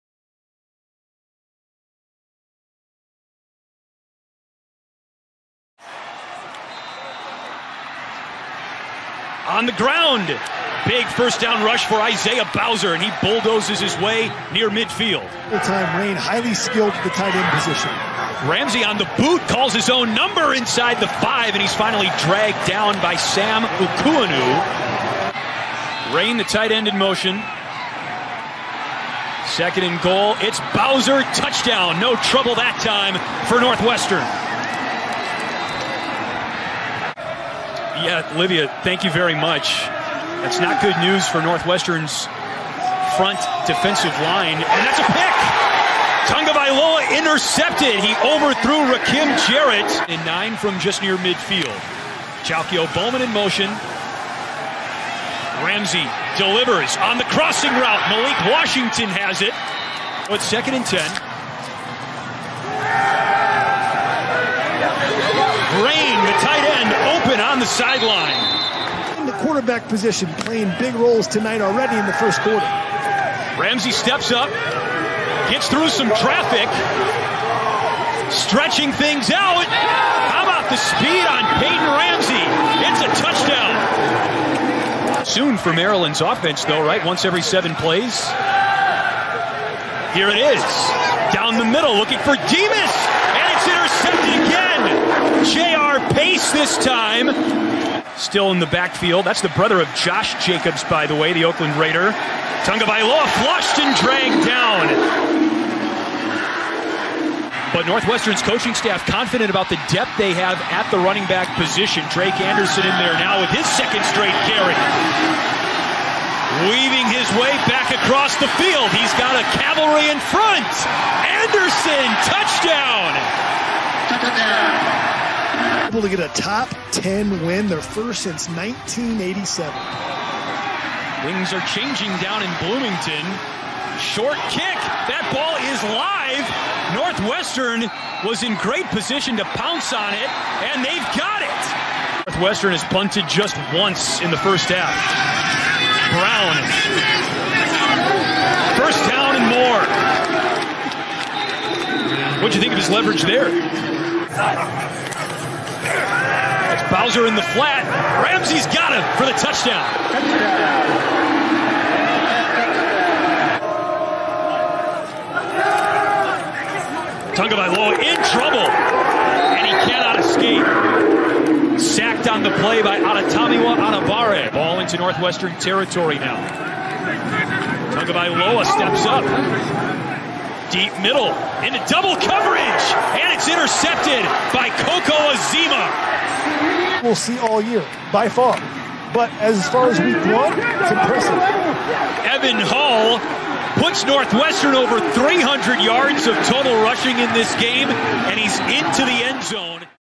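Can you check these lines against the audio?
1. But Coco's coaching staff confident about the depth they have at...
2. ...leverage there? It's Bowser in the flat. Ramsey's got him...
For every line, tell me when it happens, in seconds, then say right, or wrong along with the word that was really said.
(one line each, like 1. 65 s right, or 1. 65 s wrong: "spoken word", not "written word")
1. 107 s wrong: "Northwestern", not "Coco"
2. 152 s right.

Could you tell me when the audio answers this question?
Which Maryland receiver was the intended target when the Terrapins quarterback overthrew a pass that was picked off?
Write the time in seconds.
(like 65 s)
48 s.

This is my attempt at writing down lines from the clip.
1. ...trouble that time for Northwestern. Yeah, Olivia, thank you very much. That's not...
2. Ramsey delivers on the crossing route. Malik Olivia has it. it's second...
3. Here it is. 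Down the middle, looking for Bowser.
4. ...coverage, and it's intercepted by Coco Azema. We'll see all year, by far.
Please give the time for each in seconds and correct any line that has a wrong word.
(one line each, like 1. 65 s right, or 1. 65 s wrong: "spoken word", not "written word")
1. 32 s right
2. 55 s wrong: "Washington", not "Olivia"
3. 90 s wrong: "Demus", not "Bowser"
4. 182 s right.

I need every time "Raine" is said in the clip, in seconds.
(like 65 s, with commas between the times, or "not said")
15 s, 26 s, 65 s.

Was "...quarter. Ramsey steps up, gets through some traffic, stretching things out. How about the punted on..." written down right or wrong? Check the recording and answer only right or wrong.
wrong.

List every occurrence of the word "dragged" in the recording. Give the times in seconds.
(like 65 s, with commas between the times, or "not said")
22 s, 103 s.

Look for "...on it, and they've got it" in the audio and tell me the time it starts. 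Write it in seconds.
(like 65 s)
139 s.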